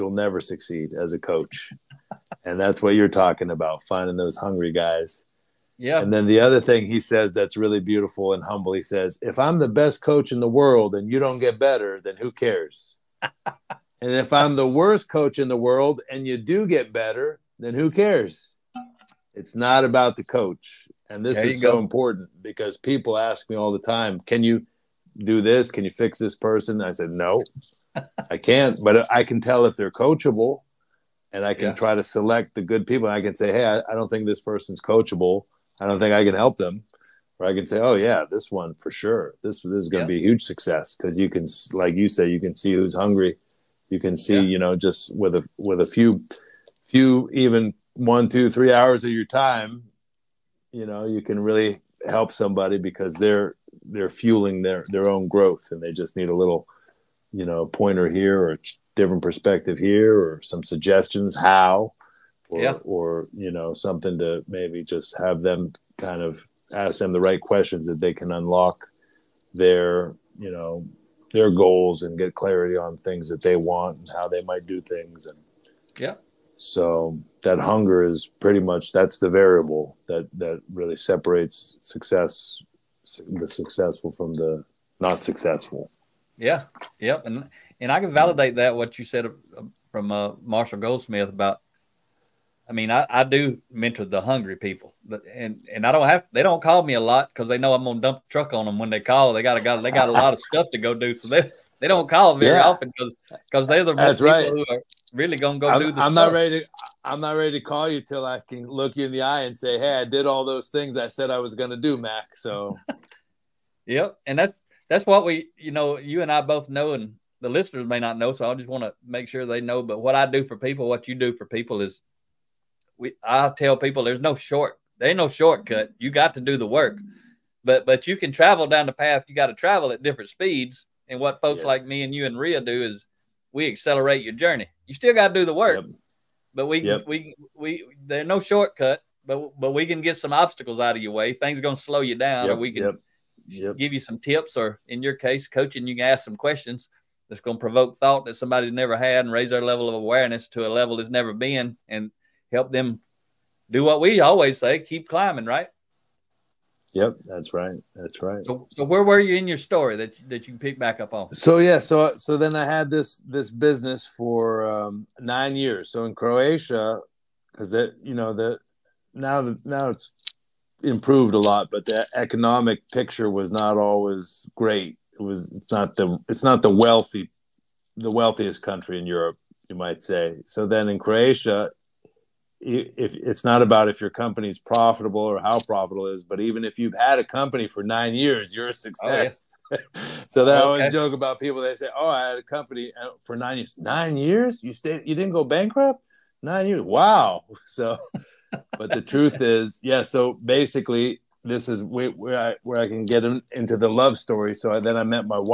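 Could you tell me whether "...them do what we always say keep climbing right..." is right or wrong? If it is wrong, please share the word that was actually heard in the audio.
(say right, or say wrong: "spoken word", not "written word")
right.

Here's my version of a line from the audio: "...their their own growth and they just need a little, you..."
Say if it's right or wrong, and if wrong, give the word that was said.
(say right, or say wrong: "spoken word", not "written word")
right.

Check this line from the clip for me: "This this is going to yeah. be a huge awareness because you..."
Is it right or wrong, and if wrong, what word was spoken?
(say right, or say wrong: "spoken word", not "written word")
wrong: "success", not "awareness".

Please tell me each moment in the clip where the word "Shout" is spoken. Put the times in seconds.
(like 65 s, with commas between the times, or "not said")
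not said.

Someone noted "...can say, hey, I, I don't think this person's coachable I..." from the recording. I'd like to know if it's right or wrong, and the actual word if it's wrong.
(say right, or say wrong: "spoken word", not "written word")
right.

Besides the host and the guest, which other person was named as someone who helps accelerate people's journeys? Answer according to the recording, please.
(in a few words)
Ria.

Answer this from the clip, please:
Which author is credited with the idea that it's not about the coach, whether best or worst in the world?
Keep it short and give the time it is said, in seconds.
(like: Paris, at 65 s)
Marshall Goldsmith, at 90 s.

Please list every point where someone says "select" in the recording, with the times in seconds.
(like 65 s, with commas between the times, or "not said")
32 s.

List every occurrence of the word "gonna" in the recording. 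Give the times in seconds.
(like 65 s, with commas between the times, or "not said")
97 s, 105 s, 111 s.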